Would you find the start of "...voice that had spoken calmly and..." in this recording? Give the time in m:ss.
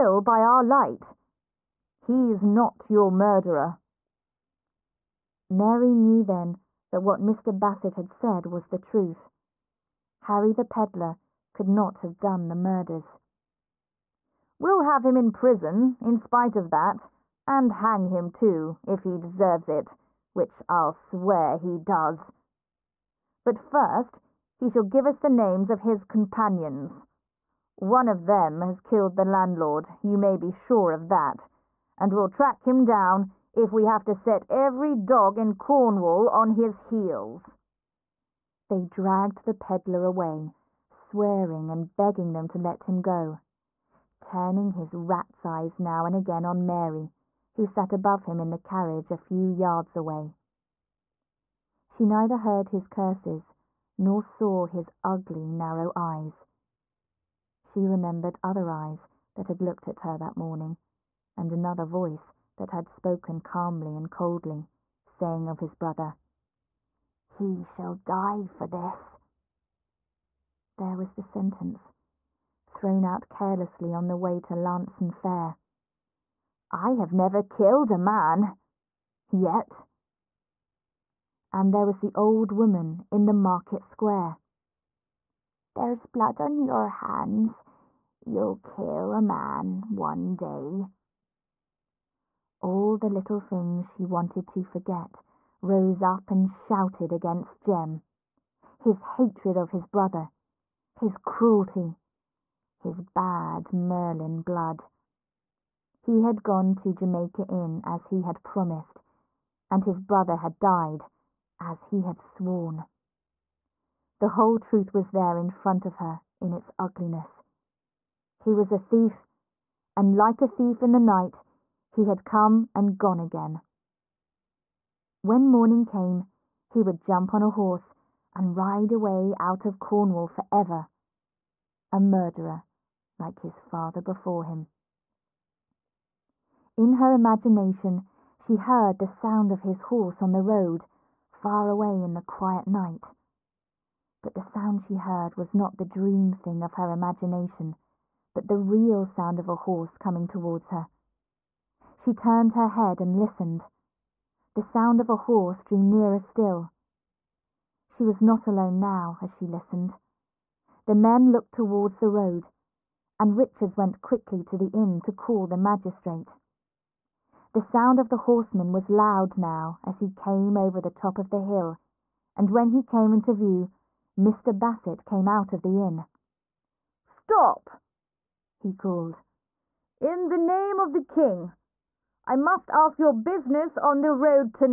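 1:01.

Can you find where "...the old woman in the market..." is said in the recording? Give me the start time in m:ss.
1:21.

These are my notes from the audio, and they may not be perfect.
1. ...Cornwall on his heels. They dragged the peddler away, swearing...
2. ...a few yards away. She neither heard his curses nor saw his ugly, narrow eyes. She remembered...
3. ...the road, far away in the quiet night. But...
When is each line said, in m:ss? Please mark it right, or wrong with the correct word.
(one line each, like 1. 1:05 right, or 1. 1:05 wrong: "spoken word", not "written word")
1. 0:35 right
2. 0:49 right
3. 2:20 right.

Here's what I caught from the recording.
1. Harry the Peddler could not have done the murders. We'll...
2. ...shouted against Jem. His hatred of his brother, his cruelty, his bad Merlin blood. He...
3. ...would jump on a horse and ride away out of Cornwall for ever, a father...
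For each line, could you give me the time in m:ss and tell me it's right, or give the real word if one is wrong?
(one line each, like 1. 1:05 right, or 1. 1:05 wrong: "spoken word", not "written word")
1. 0:10 right
2. 1:36 right
3. 2:06 wrong: "murderer", not "father".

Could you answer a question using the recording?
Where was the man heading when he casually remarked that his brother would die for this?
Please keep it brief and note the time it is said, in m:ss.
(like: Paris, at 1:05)
Launceston Fair, at 1:14.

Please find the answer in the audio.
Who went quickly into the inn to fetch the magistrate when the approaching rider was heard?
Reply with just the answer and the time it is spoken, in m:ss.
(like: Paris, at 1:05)
Richards, at 2:43.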